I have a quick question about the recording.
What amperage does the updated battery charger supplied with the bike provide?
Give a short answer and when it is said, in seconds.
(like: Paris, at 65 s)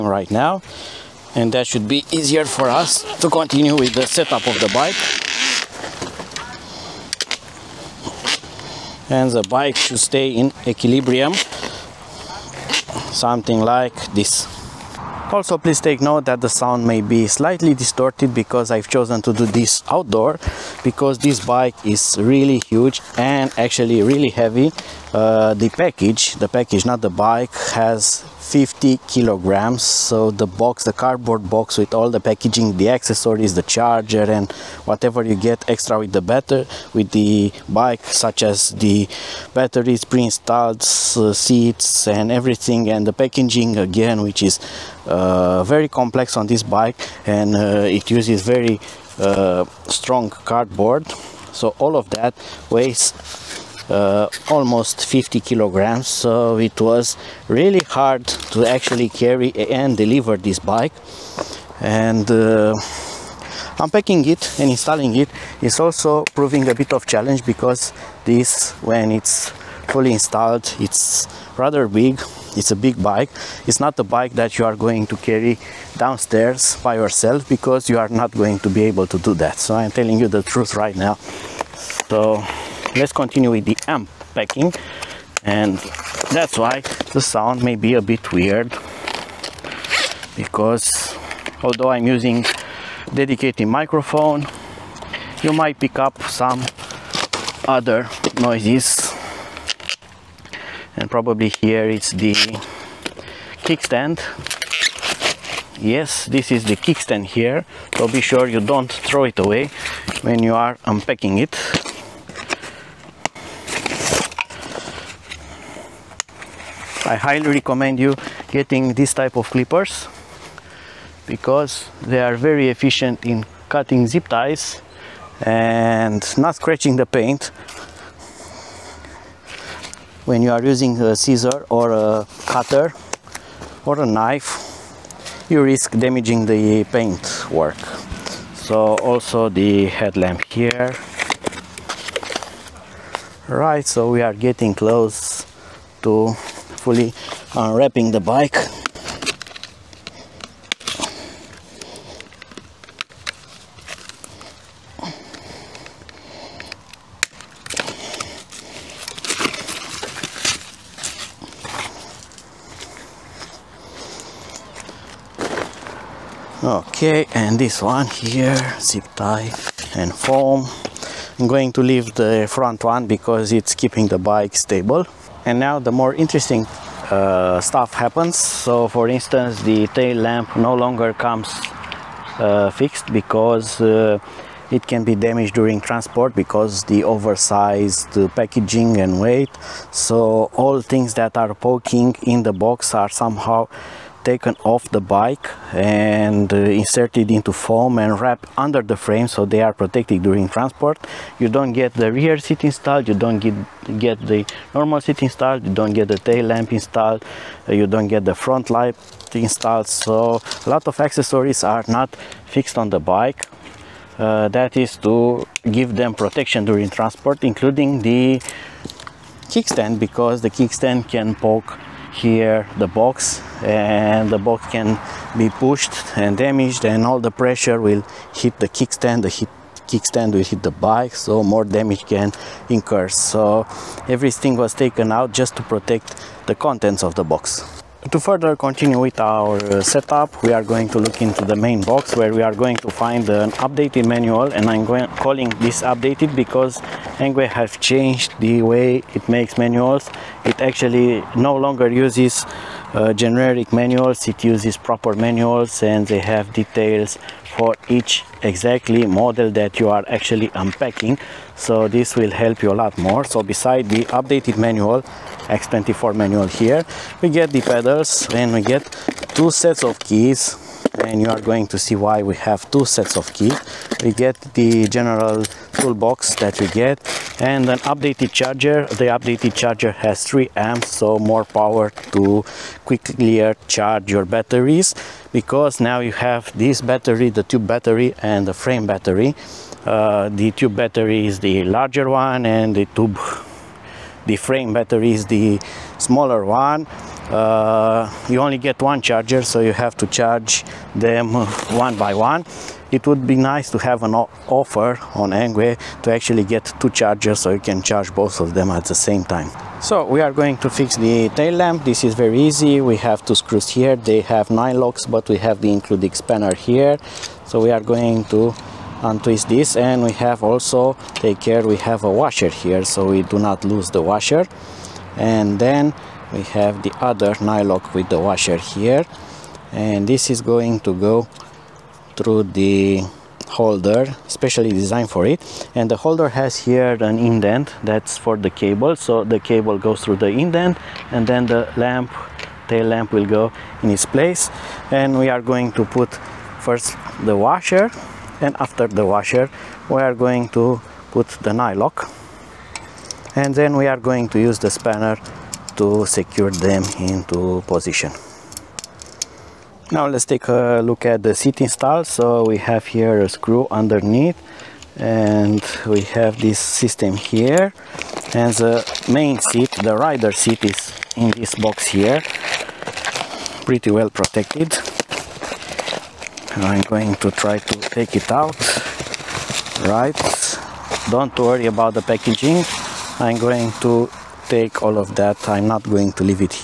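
3 amps, at 280 s.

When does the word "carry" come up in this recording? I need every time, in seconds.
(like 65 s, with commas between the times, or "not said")
59 s, 75 s.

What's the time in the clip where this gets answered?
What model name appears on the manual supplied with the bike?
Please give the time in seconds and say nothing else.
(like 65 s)
265 s.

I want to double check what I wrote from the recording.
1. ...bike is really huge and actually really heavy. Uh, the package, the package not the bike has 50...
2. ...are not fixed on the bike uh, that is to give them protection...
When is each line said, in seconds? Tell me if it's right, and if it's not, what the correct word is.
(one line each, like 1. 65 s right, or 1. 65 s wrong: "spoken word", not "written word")
1. 21 s right
2. 211 s right.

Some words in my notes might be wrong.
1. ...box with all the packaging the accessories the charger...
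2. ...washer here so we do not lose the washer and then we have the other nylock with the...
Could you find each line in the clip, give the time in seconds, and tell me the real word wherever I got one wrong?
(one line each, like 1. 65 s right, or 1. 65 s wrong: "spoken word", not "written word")
1. 31 s right
2. 322 s right.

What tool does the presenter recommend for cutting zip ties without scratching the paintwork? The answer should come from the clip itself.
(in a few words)
clippers.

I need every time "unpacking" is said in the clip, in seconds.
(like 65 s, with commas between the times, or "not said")
63 s, 110 s, 260 s.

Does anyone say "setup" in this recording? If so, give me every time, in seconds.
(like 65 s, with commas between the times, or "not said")
4 s, 239 s.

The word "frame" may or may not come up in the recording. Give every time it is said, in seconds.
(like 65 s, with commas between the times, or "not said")
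198 s, 288 s, 294 s.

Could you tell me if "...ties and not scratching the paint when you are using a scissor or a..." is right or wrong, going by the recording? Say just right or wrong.
right.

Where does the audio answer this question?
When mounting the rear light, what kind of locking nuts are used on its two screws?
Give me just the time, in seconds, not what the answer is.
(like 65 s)
314 s.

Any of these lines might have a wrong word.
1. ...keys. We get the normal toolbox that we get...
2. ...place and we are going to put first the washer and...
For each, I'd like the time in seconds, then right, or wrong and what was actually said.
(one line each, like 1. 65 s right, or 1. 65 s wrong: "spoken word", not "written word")
1. 273 s wrong: "general", not "normal"
2. 344 s right.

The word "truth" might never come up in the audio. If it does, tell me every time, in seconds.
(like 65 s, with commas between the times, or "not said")
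80 s.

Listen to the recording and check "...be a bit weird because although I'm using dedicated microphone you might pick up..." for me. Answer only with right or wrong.
right.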